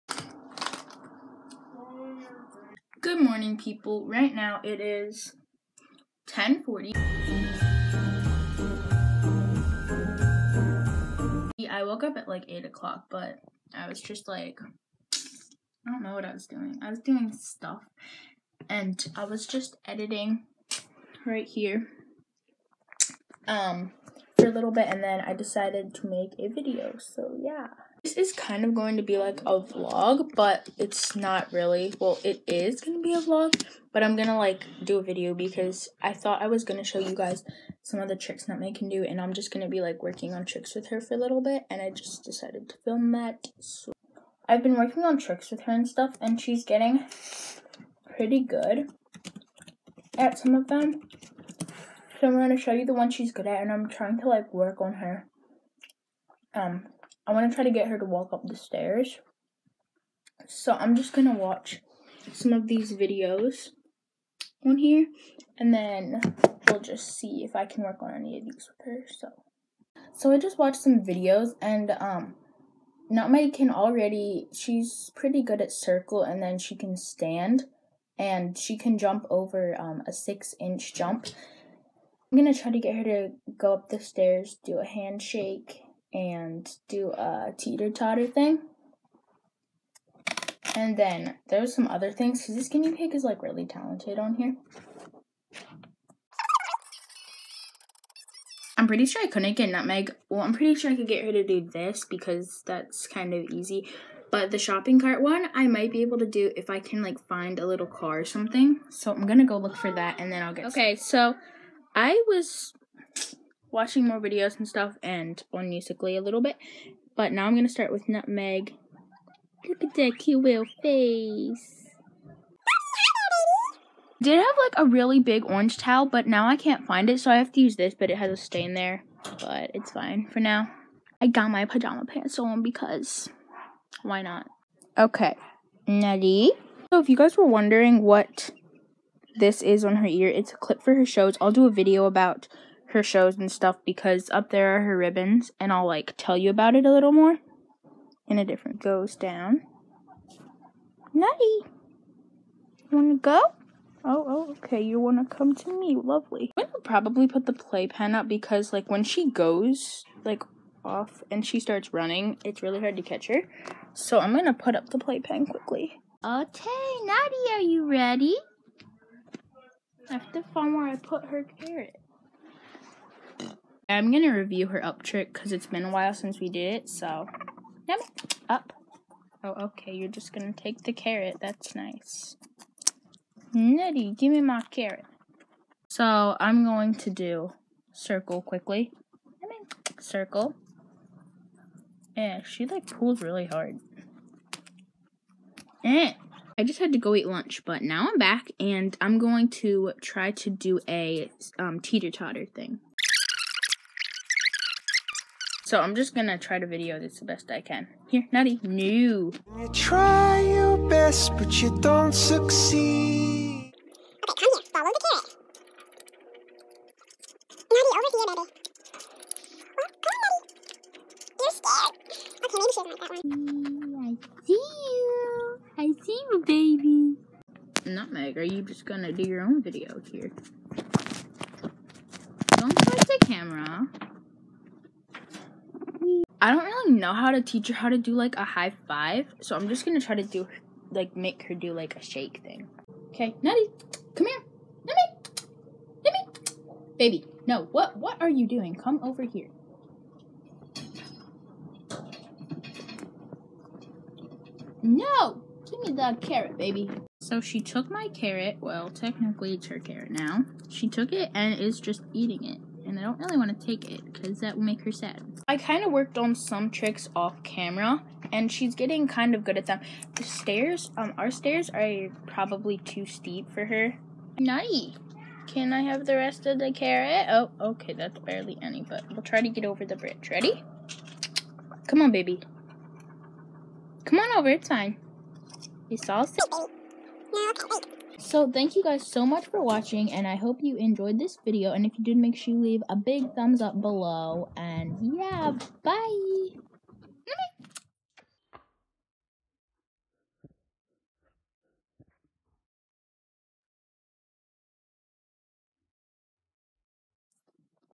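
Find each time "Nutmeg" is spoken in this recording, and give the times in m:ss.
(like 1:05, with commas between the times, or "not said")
0:38, 1:13, 1:39, 1:58, 3:47.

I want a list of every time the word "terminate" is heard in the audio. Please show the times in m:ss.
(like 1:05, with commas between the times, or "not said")
not said.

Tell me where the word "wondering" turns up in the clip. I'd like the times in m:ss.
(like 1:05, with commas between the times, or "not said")
2:17.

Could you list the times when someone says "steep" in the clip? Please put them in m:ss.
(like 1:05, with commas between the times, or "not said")
4:33.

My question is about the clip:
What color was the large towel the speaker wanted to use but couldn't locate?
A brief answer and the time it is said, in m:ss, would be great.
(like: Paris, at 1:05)
Orange, at 2:05.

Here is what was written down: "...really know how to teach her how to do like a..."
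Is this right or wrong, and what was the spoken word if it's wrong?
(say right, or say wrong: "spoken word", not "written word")
right.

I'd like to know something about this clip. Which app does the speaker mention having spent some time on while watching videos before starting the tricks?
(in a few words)
Musically.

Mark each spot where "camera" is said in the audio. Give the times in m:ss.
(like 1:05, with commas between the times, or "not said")
3:53, 4:27.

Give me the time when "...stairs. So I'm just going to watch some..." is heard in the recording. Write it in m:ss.
0:58.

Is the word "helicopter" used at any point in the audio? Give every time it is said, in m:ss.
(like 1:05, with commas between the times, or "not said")
not said.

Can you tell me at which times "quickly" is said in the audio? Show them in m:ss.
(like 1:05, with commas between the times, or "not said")
2:45, 3:08.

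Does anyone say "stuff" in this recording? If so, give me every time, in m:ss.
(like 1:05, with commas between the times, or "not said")
0:17, 0:45, 1:54, 2:23.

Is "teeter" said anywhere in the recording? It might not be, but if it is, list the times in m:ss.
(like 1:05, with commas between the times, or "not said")
1:27, 3:21.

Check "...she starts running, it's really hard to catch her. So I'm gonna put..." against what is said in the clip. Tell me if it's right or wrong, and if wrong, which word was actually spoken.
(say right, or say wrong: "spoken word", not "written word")
right.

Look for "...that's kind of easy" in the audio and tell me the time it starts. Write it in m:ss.
1:42.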